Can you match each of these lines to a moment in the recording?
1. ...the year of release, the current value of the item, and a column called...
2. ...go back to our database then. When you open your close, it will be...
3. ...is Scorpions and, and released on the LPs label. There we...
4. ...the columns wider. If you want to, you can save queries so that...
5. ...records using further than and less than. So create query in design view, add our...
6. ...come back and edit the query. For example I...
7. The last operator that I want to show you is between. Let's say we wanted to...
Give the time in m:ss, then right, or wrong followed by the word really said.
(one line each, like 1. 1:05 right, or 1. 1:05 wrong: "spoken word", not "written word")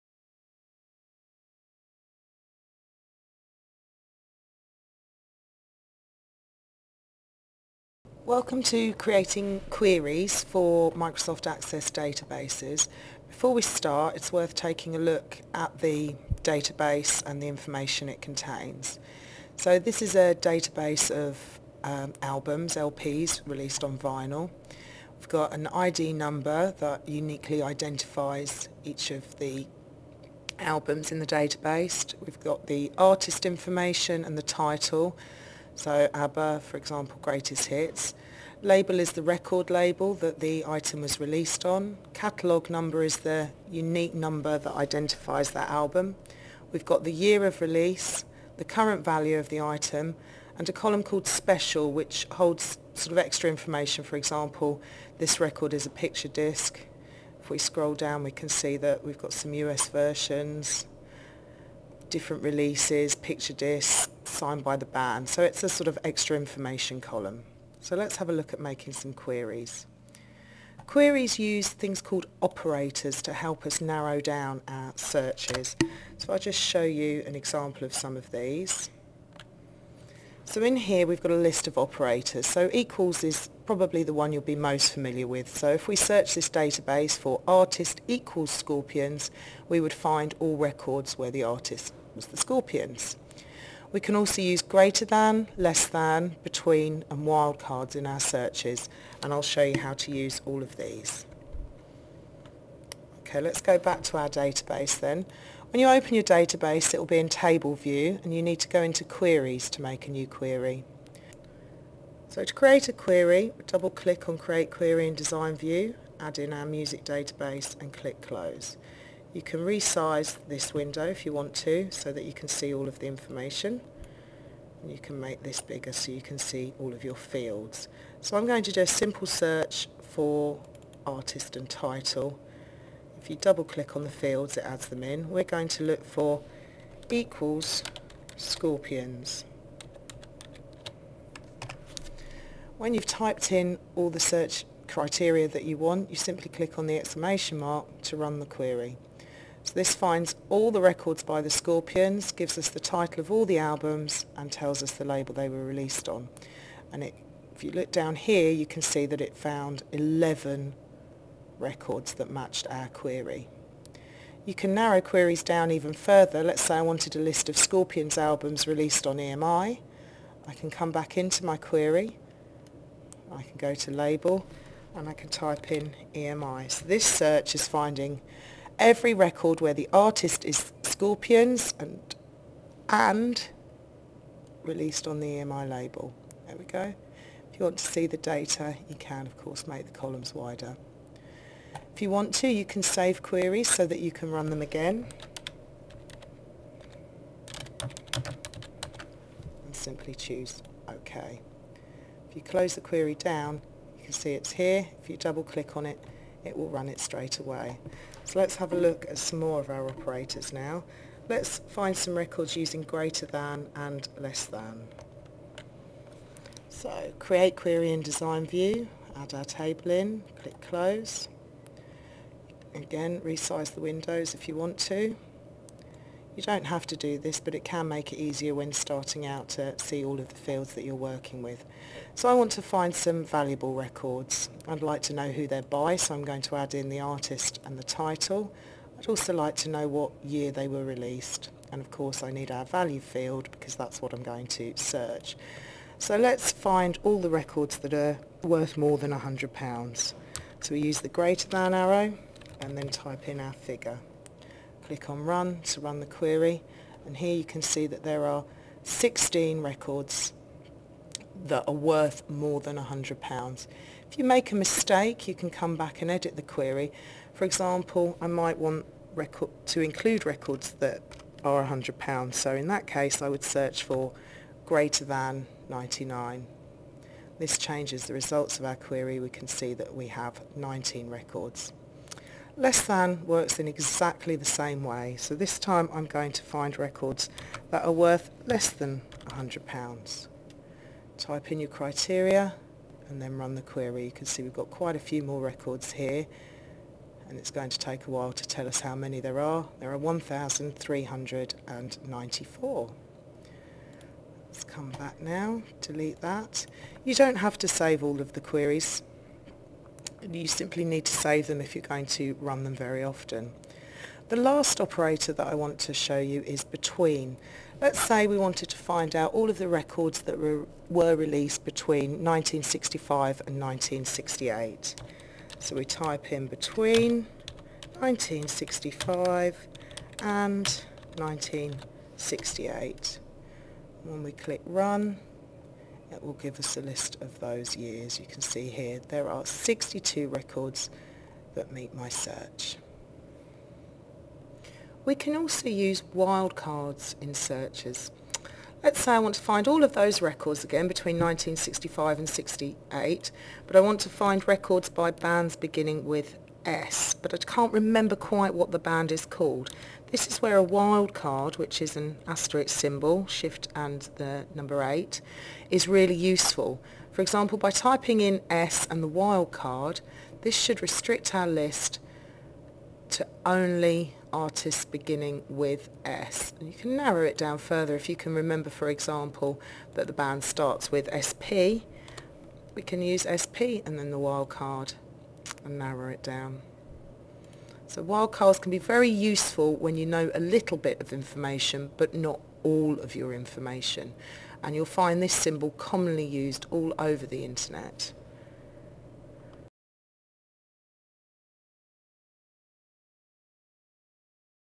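1. 0:47 right
2. 1:43 wrong: "database", not "close"
3. 3:00 wrong: "EMI", not "LPs"
4. 3:09 right
5. 3:32 wrong: "greater", not "further"
6. 4:25 right
7. 5:14 right.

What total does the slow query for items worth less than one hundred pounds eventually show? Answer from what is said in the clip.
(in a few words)
1394.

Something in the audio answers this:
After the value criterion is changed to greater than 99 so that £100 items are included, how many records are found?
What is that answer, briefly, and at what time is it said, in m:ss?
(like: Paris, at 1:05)
19, at 4:40.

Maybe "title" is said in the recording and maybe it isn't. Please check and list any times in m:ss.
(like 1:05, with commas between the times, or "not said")
0:34, 2:11, 2:32, 3:57.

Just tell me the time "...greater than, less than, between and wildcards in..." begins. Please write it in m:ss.
1:34.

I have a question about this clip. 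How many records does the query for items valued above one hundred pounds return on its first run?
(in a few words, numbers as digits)
16.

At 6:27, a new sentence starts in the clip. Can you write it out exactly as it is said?
So wildcards can be very useful when you know a little bit of information but not all of your information.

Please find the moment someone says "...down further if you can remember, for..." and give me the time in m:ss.
6:17.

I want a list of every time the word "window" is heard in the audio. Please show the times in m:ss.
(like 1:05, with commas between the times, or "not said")
2:00, 3:43.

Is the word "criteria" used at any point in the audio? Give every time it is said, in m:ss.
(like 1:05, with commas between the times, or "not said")
2:24, 4:51.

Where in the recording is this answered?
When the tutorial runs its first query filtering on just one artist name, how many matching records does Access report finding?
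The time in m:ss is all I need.
2:39.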